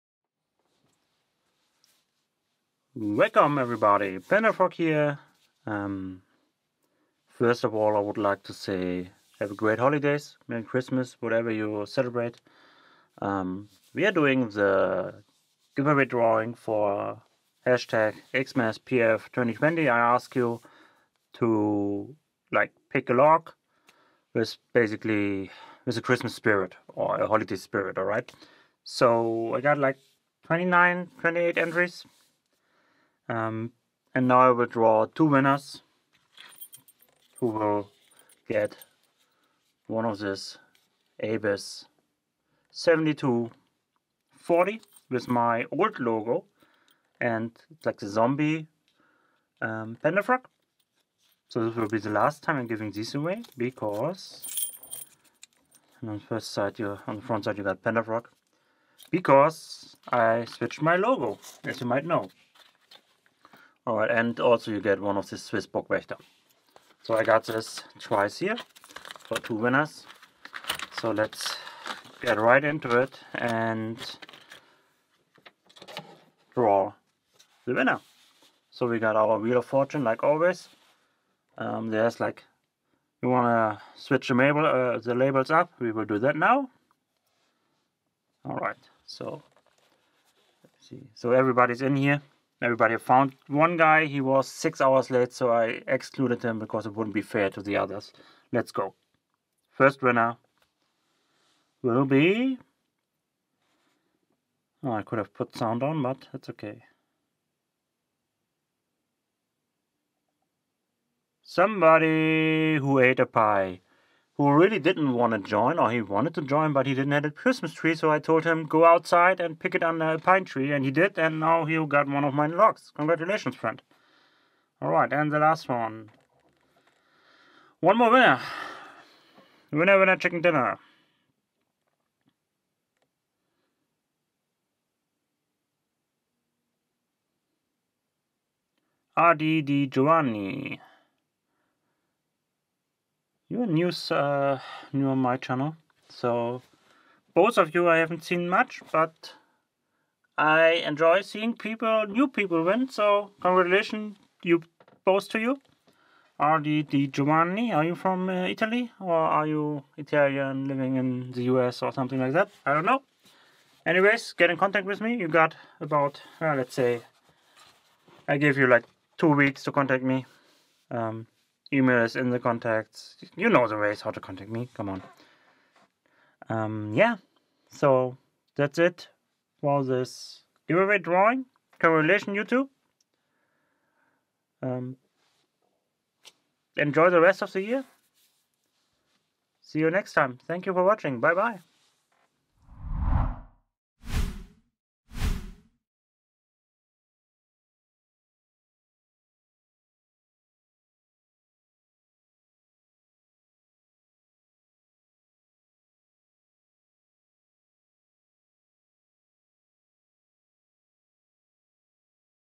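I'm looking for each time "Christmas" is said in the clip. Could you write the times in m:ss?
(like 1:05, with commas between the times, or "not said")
0:10, 0:26, 1:57.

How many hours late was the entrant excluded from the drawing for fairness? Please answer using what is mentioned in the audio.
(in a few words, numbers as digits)
6.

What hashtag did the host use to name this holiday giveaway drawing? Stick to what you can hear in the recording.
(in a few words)
XMASPF2020.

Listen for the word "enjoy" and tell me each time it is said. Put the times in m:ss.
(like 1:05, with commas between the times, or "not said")
2:30, 3:06.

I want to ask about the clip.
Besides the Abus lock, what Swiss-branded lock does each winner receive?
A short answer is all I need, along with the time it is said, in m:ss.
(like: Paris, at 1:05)
Burg Wächter, at 1:05.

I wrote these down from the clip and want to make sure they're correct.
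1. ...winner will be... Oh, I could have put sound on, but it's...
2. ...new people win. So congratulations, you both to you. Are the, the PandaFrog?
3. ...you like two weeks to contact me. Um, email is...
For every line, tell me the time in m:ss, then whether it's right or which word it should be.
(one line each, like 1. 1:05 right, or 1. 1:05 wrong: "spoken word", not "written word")
1. 1:40 right
2. 2:32 wrong: "Giovanni", not "PandaFrog"
3. 2:48 right.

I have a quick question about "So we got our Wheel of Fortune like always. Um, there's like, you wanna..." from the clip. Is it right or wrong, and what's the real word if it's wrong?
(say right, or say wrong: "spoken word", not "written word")
right.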